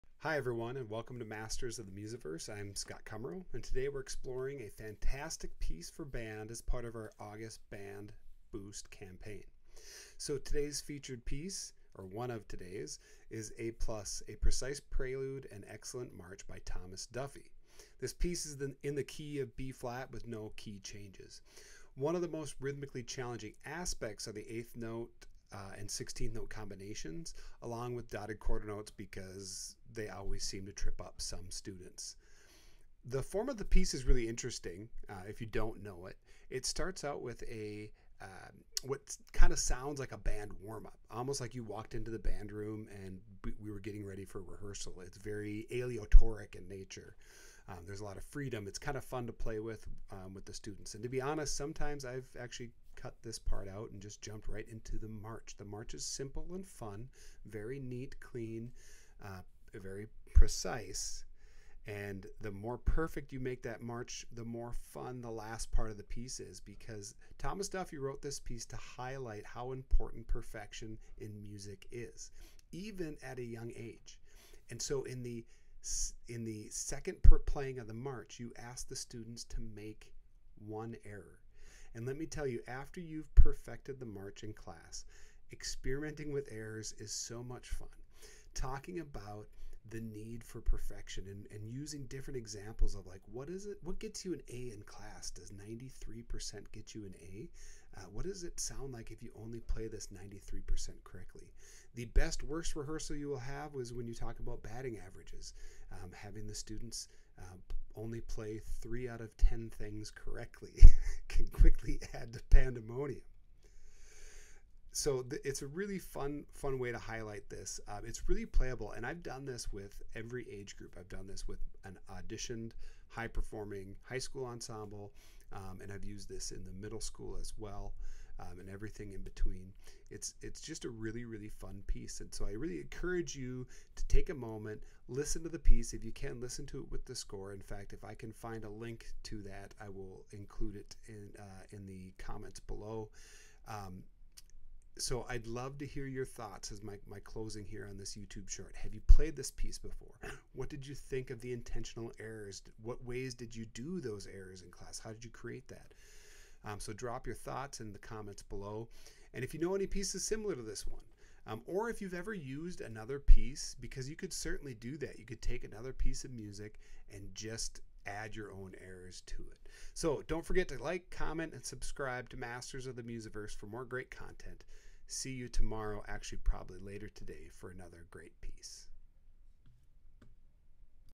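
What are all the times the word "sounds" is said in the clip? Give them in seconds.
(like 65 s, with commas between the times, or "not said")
39 s, 98 s.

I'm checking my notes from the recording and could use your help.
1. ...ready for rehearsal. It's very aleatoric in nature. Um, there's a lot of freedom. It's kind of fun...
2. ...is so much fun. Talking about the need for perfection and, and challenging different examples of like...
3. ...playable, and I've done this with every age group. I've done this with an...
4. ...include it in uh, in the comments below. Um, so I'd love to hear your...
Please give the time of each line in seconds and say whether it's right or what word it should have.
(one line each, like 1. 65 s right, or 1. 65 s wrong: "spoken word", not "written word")
1. 44 s right
2. 86 s wrong: "using", not "challenging"
3. 118 s right
4. 140 s right.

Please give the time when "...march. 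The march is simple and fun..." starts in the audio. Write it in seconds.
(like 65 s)
55 s.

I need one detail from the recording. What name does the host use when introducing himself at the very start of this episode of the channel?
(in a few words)
Scott Kummrow.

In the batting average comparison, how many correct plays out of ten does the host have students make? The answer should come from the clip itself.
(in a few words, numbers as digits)
3 out of 10.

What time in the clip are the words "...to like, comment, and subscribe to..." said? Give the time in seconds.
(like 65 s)
170 s.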